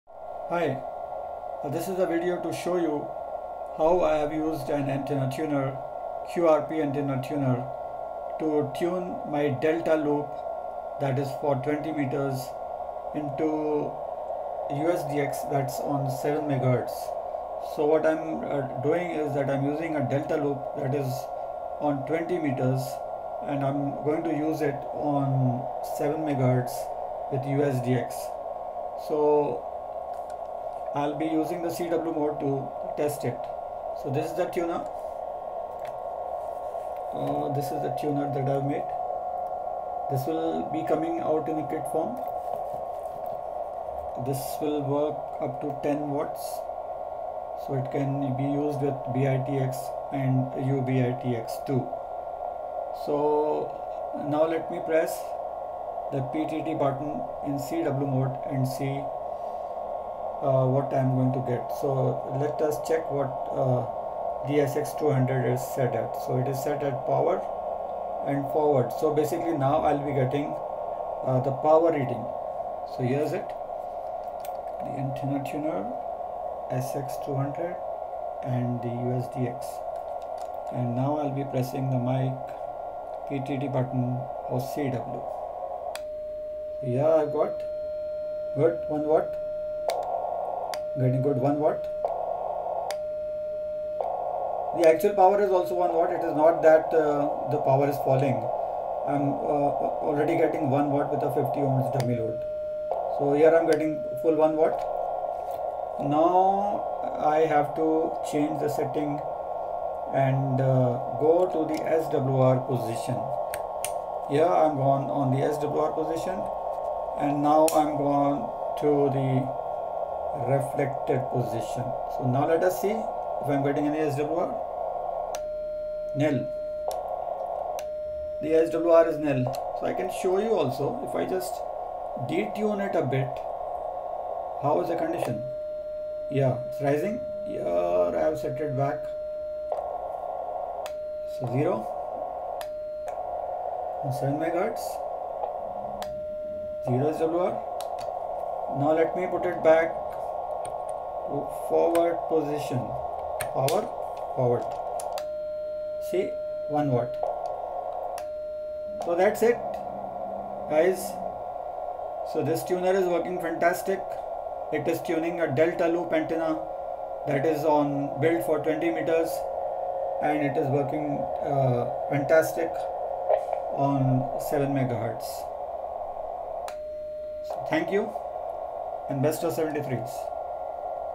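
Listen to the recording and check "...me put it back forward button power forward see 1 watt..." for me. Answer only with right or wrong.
wrong.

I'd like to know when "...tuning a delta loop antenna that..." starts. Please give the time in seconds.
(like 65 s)
165 s.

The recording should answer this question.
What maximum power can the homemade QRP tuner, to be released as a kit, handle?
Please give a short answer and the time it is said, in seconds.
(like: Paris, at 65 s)
10 watts, at 45 s.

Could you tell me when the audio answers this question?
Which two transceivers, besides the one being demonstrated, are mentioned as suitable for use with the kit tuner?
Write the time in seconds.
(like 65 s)
49 s.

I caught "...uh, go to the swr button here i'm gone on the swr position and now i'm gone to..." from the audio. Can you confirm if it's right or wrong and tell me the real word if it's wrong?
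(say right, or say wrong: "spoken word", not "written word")
wrong: "position", not "button".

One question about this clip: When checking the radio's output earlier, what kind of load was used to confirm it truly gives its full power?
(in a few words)
50 ohms dummy load.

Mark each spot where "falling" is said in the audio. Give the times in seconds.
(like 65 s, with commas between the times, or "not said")
98 s.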